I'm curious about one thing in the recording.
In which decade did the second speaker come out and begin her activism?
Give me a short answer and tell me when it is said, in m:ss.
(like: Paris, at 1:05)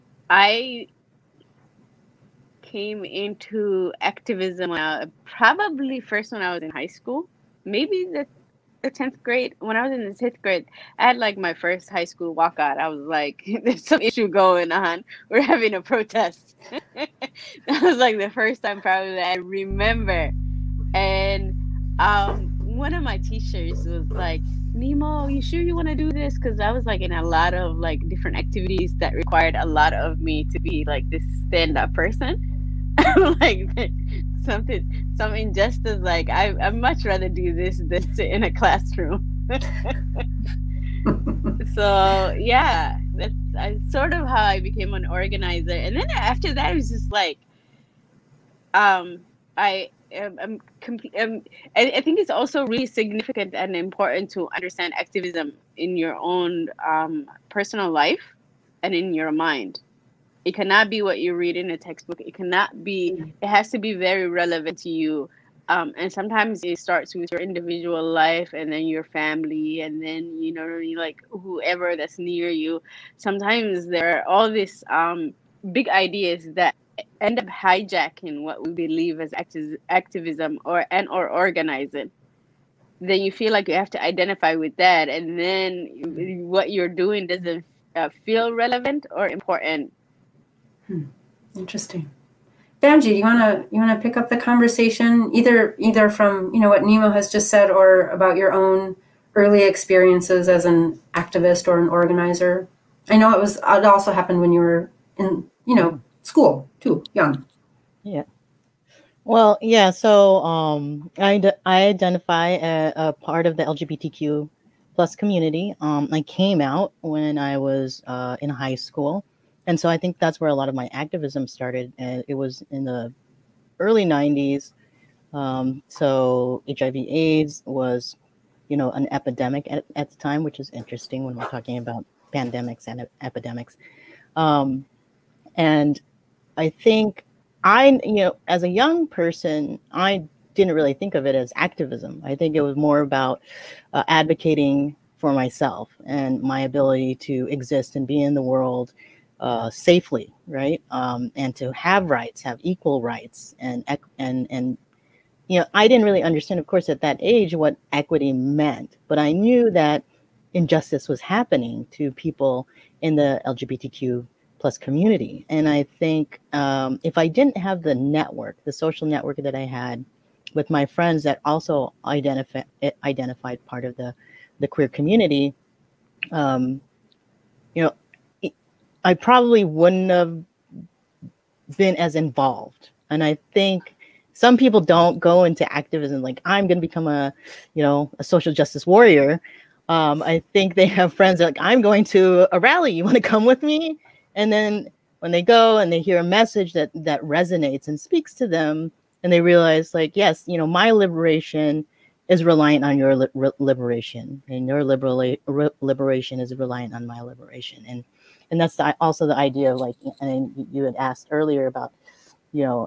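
the early '90s, at 2:03.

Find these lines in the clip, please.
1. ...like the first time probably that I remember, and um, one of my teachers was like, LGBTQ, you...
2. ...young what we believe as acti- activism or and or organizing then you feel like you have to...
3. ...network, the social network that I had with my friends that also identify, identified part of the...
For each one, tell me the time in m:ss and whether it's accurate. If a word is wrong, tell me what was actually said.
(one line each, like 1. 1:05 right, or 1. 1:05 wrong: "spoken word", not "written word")
1. 0:17 wrong: "Nimo", not "LGBTQ"
2. 1:17 wrong: "hijacking", not "young"
3. 2:47 right.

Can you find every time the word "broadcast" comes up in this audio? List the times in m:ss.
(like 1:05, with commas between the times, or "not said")
not said.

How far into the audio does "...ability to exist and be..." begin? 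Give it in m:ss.
2:26.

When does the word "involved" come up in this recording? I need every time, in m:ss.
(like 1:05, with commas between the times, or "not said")
3:02.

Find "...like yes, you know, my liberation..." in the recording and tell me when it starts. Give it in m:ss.
3:19.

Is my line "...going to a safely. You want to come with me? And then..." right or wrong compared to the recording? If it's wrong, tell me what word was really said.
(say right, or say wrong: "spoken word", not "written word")
wrong: "rally", not "safely".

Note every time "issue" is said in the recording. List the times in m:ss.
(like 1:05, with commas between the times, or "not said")
0:14.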